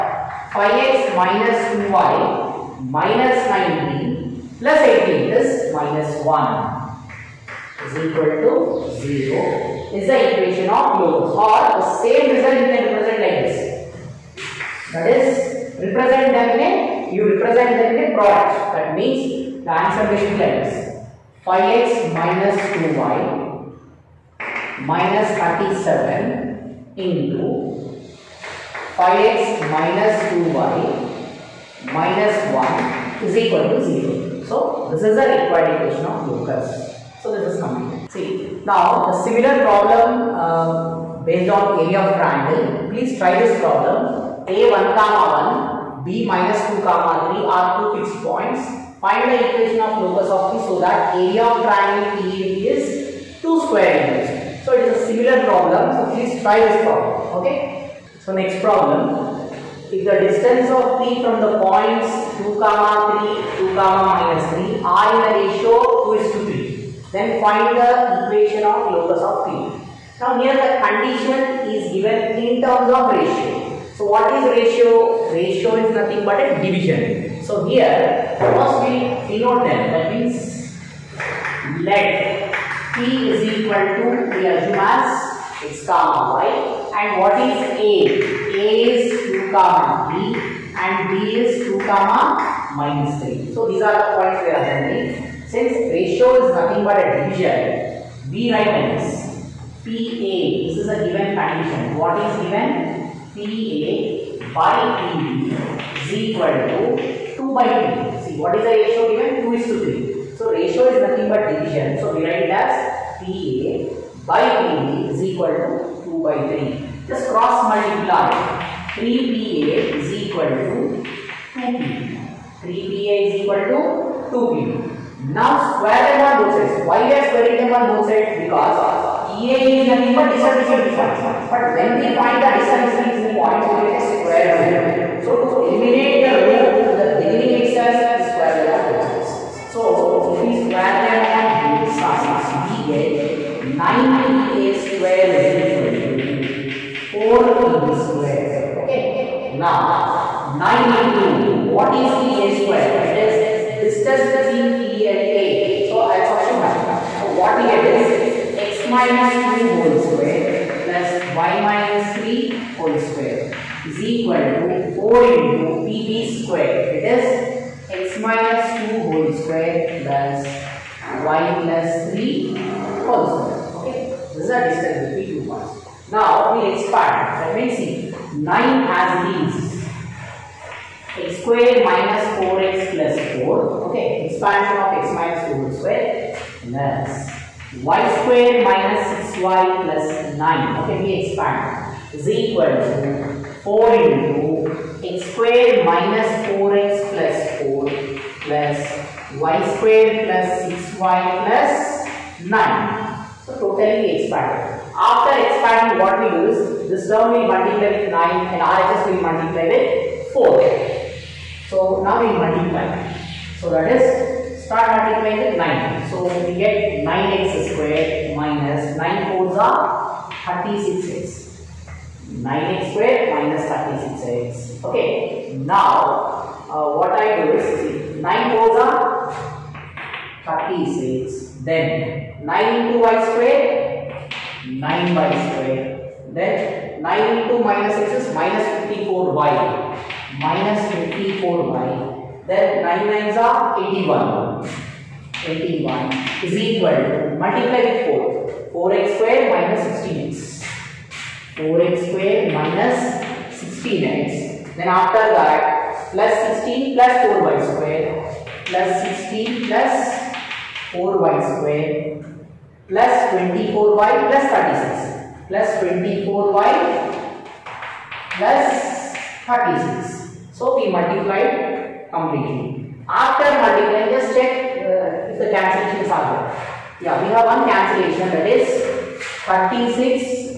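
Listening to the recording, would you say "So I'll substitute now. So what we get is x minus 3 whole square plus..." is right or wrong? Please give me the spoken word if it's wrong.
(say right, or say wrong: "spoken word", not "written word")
wrong: "2", not "3".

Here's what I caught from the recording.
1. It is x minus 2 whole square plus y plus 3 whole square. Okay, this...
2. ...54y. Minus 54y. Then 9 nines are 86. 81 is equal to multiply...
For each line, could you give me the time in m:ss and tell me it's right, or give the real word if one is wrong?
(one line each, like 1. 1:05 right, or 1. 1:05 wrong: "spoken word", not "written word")
1. 2:46 right
2. 3:58 wrong: "81", not "86".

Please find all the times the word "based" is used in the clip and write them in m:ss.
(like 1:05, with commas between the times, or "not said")
0:41.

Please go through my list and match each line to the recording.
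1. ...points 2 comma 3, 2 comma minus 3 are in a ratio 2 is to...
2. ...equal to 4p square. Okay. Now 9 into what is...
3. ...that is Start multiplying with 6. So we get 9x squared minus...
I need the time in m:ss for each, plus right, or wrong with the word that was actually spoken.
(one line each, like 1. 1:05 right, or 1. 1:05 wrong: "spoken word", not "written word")
1. 1:01 right
2. 2:25 right
3. 3:33 wrong: "9", not "6".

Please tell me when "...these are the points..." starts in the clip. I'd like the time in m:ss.
1:33.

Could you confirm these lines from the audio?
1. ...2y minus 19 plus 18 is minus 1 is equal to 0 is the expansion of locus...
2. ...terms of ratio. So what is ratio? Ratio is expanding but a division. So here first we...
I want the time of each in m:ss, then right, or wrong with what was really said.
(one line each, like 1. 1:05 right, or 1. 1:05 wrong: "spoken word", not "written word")
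1. 0:01 wrong: "equation", not "expansion"
2. 1:12 wrong: "nothing", not "expanding".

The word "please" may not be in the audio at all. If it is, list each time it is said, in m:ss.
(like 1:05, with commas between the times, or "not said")
0:42, 0:56.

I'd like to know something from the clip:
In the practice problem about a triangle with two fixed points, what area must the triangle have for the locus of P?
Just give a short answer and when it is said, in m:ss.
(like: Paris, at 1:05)
2 square units, at 0:53.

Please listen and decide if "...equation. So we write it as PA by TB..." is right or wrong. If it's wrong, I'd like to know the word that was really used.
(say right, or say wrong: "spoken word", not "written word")
wrong: "division", not "equation".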